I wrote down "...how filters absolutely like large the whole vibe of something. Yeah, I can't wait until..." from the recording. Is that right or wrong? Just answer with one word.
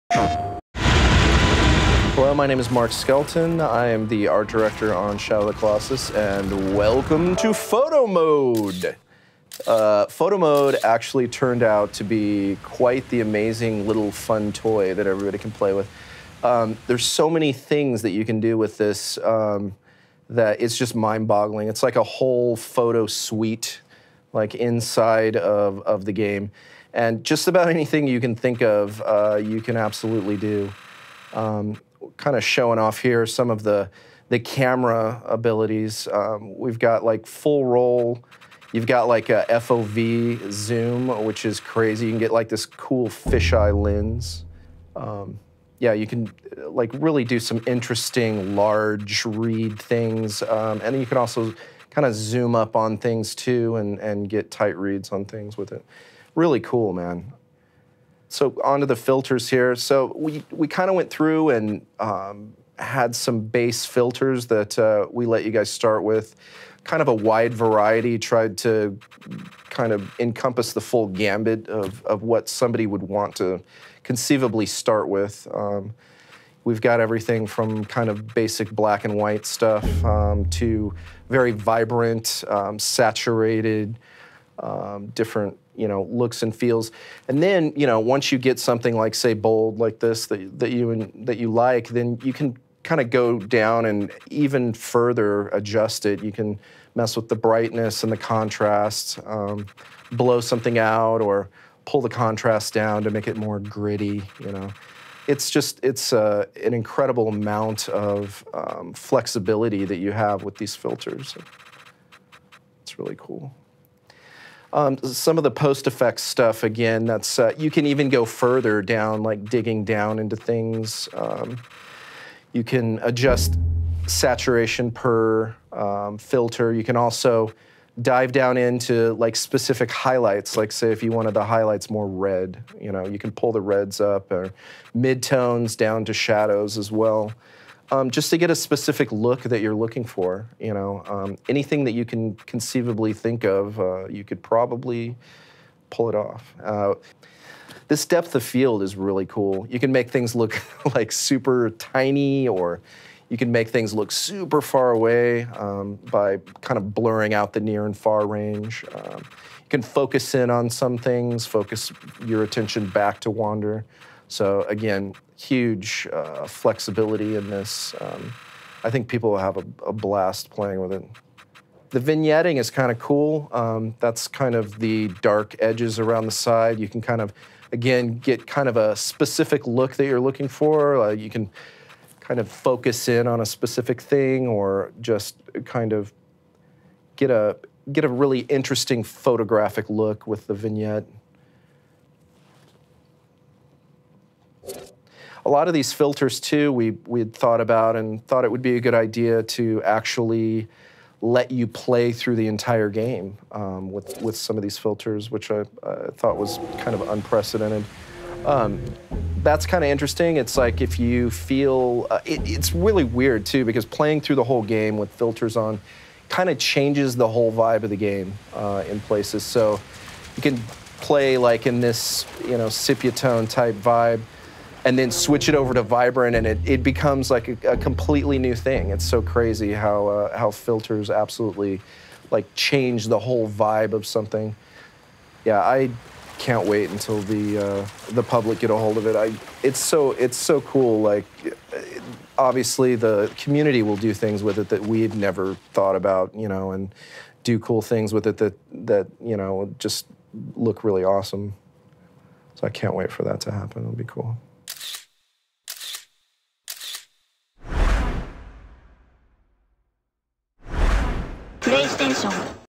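wrong.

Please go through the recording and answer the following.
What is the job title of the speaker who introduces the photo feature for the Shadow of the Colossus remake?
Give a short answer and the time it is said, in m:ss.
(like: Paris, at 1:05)
Art director, at 0:04.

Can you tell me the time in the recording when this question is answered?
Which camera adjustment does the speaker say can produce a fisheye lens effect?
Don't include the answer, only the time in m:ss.
0:39.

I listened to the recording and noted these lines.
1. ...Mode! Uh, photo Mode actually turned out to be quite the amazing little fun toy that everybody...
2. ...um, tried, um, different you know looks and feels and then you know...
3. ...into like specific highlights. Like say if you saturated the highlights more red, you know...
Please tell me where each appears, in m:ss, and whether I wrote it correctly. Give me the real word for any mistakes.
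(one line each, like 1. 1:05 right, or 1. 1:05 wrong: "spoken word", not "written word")
1. 0:08 right
2. 1:22 wrong: "saturated", not "tried"
3. 2:08 wrong: "wanted", not "saturated".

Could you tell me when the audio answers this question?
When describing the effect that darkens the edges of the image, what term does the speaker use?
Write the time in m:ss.
2:51.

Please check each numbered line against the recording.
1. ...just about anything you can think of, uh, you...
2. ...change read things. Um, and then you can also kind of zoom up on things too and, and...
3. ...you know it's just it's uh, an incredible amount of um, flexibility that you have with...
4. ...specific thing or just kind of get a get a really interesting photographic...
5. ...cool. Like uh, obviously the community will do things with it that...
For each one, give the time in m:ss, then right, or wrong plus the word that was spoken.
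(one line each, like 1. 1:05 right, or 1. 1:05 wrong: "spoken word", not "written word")
1. 0:27 right
2. 0:48 wrong: "large", not "change"
3. 1:44 right
4. 3:03 right
5. 4:00 right.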